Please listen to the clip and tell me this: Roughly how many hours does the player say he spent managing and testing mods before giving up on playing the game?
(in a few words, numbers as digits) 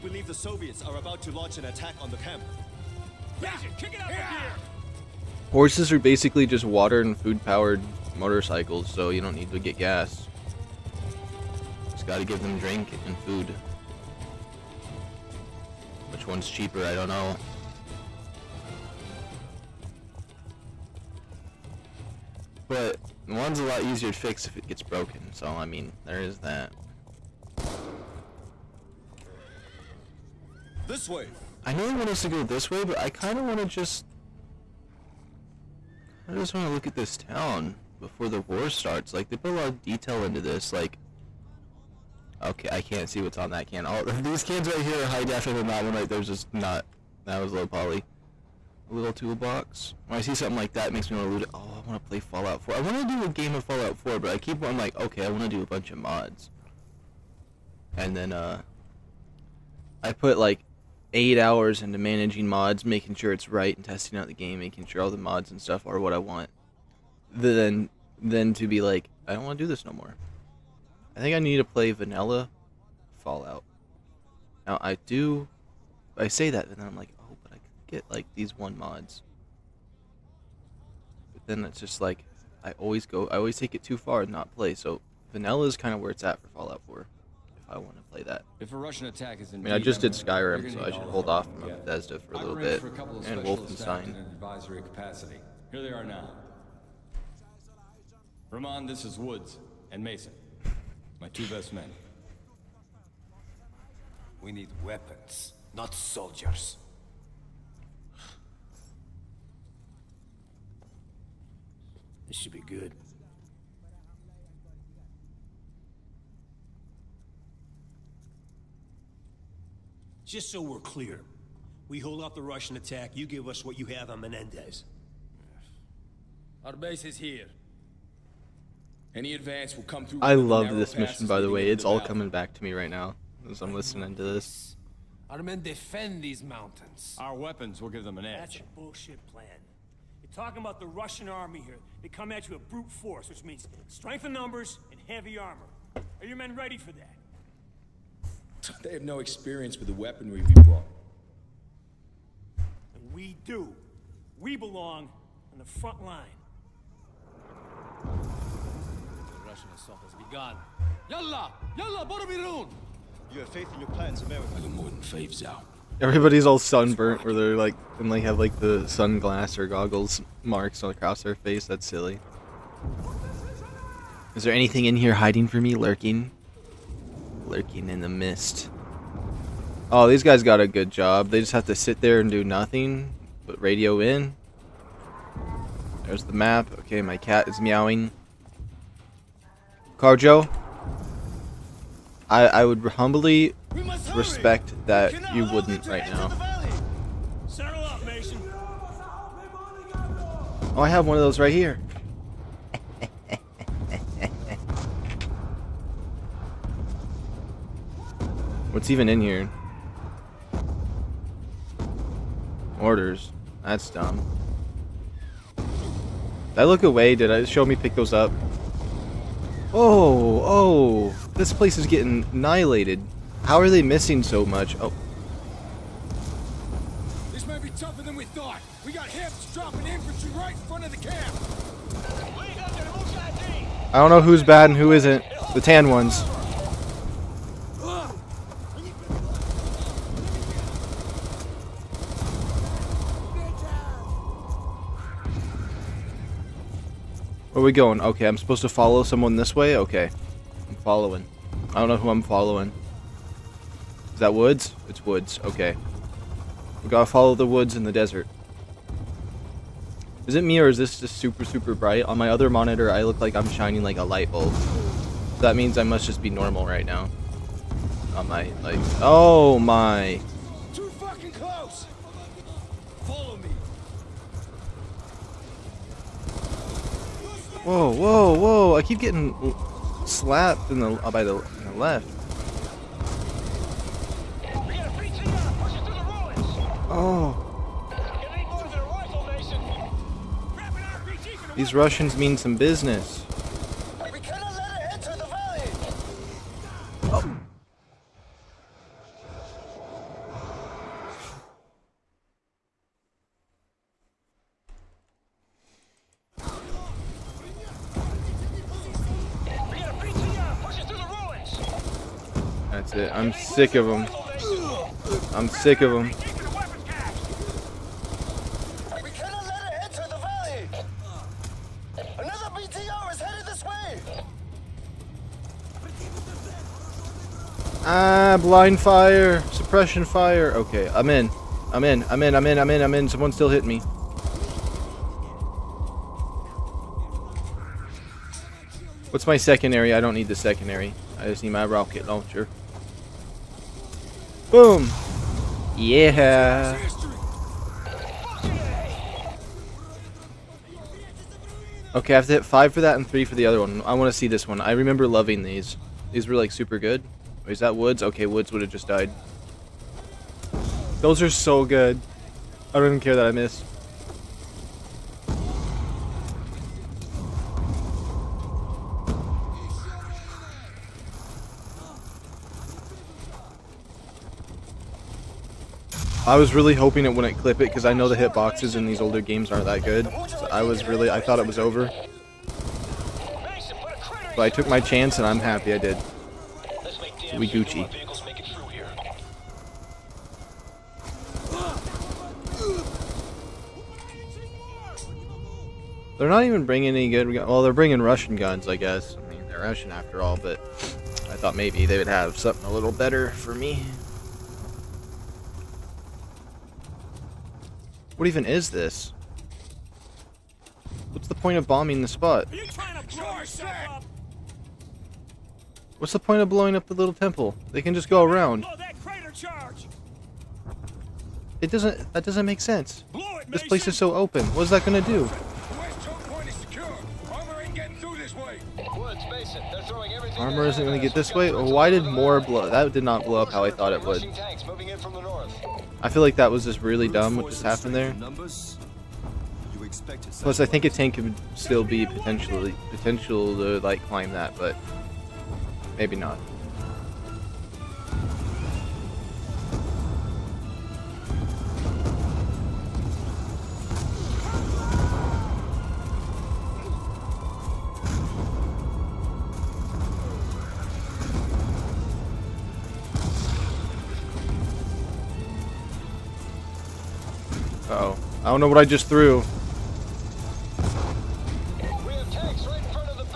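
8.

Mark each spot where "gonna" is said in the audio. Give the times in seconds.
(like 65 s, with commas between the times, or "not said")
424 s, 430 s.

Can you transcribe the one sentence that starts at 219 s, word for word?
Oh, oh, this place is getting annihilated.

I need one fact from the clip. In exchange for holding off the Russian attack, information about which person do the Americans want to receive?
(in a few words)
Menendez.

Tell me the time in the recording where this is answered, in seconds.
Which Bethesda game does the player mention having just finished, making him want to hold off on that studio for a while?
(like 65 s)
90 s.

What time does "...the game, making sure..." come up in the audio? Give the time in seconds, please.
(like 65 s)
64 s.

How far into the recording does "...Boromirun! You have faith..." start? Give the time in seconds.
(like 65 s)
162 s.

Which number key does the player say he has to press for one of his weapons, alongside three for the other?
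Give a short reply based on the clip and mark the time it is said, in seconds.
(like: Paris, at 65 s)
5, at 352 s.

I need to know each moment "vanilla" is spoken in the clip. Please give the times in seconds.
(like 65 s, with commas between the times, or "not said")
71 s, 85 s.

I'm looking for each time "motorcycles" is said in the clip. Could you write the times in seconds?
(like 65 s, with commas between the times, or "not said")
8 s.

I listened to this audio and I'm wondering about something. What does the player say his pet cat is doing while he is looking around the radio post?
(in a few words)
meowing.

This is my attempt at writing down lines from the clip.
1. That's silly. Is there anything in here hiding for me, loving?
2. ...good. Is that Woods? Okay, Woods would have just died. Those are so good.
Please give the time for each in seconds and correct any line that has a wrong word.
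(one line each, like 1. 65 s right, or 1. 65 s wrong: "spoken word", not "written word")
1. 171 s wrong: "lurking", not "loving"
2. 356 s right.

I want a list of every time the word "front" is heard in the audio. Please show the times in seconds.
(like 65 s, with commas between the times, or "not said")
155 s, 230 s.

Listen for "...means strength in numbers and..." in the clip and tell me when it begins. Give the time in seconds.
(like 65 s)
143 s.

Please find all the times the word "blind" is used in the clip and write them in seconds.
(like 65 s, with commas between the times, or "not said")
328 s.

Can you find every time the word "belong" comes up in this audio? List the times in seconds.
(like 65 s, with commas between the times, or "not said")
154 s.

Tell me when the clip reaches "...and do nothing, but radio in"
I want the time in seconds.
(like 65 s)
182 s.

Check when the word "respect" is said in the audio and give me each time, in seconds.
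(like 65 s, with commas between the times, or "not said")
194 s.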